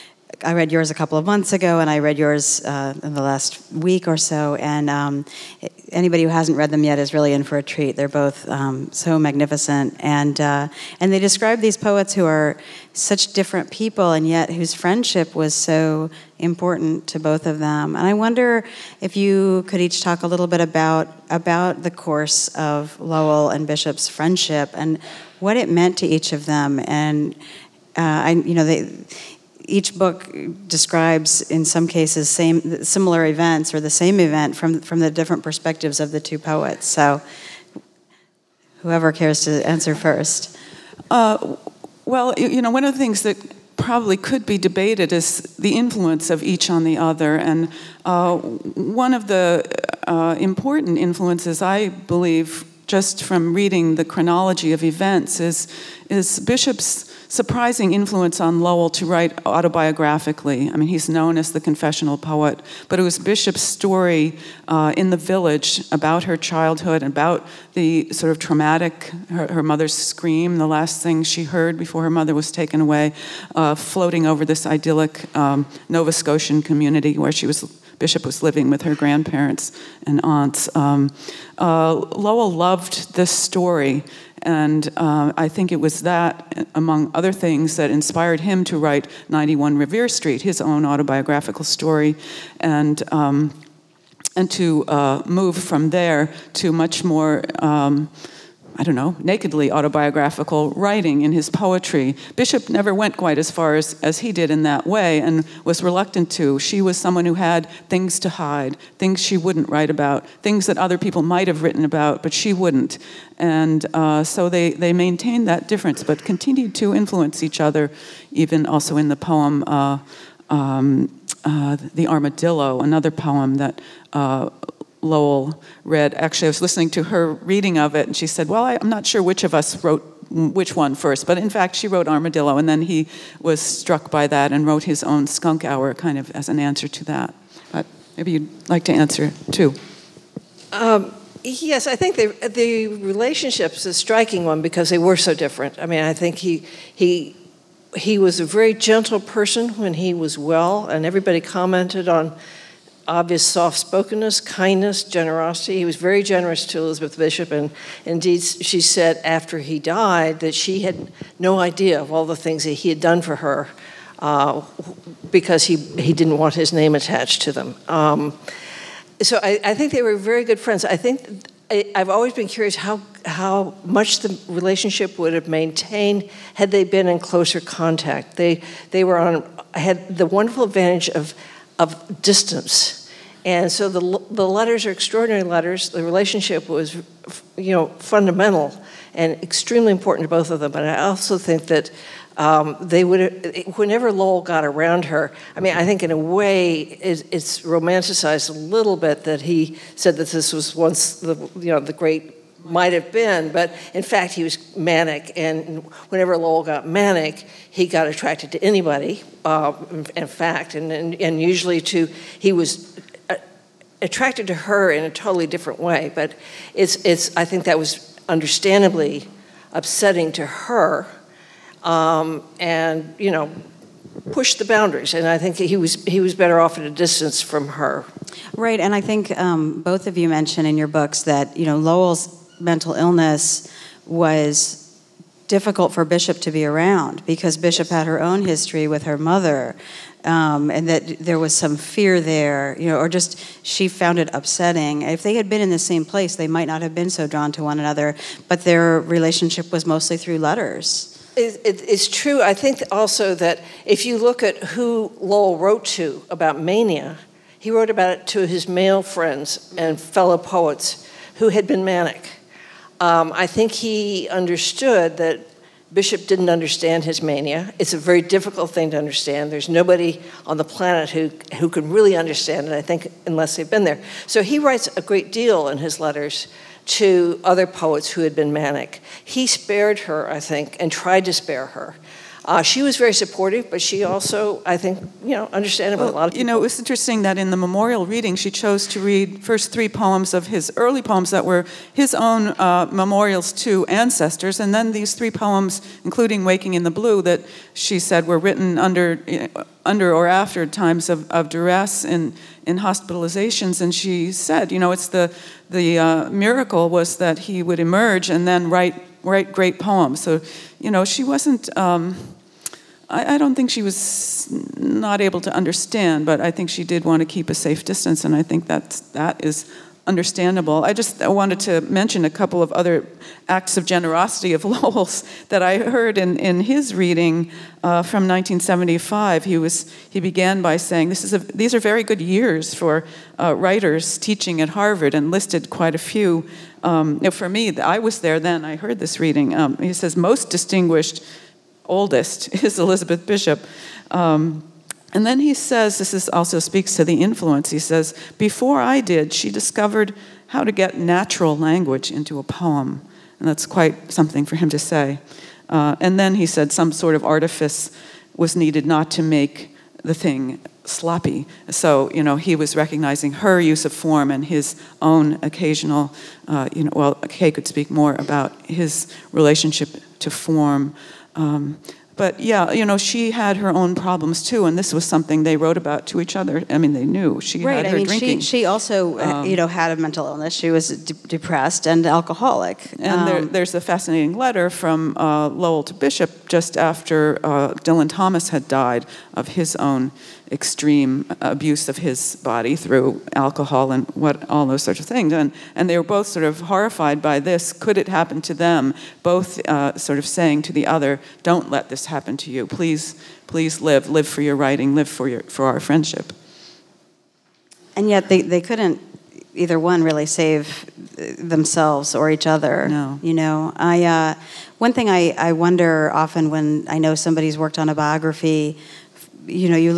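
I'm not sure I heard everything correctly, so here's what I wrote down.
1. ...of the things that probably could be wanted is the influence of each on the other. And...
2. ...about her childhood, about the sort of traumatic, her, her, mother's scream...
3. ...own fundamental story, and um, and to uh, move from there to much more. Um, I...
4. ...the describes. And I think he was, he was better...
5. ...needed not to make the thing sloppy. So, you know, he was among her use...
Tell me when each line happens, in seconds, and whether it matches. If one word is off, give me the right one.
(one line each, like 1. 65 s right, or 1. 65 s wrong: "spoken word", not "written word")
1. 42 s wrong: "debated", not "wanted"
2. 65 s right
3. 90 s wrong: "autobiographical", not "fundamental"
4. 224 s wrong: "boundaries", not "describes"
5. 358 s wrong: "recognizing", not "among".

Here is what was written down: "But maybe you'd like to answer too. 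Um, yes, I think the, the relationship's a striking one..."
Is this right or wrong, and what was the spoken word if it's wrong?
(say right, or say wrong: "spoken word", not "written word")
right.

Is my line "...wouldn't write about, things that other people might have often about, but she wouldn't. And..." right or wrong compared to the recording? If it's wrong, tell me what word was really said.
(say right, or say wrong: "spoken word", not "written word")
wrong: "written", not "often".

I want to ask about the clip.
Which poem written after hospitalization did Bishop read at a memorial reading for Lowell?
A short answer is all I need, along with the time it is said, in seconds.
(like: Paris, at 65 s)
Waking in the Blue, at 296 s.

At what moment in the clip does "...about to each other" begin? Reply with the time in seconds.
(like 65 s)
375 s.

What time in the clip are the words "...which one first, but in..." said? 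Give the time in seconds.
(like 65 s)
130 s.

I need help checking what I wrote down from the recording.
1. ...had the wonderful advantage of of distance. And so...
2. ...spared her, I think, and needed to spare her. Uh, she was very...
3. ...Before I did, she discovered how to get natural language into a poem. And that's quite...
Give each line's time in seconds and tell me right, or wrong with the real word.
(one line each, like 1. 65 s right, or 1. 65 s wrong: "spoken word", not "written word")
1. 179 s right
2. 279 s wrong: "tried", not "needed"
3. 348 s right.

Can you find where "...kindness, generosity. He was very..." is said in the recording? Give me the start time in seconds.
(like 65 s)
154 s.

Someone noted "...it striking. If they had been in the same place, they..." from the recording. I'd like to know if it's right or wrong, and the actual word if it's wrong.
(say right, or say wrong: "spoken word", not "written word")
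wrong: "upsetting", not "striking".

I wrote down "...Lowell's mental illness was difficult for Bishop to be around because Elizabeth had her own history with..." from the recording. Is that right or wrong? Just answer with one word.
wrong.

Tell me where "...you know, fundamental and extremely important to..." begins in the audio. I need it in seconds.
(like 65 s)
187 s.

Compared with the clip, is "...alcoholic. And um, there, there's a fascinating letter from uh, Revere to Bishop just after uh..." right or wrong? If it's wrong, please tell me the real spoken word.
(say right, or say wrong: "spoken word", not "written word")
wrong: "Lowell", not "Revere".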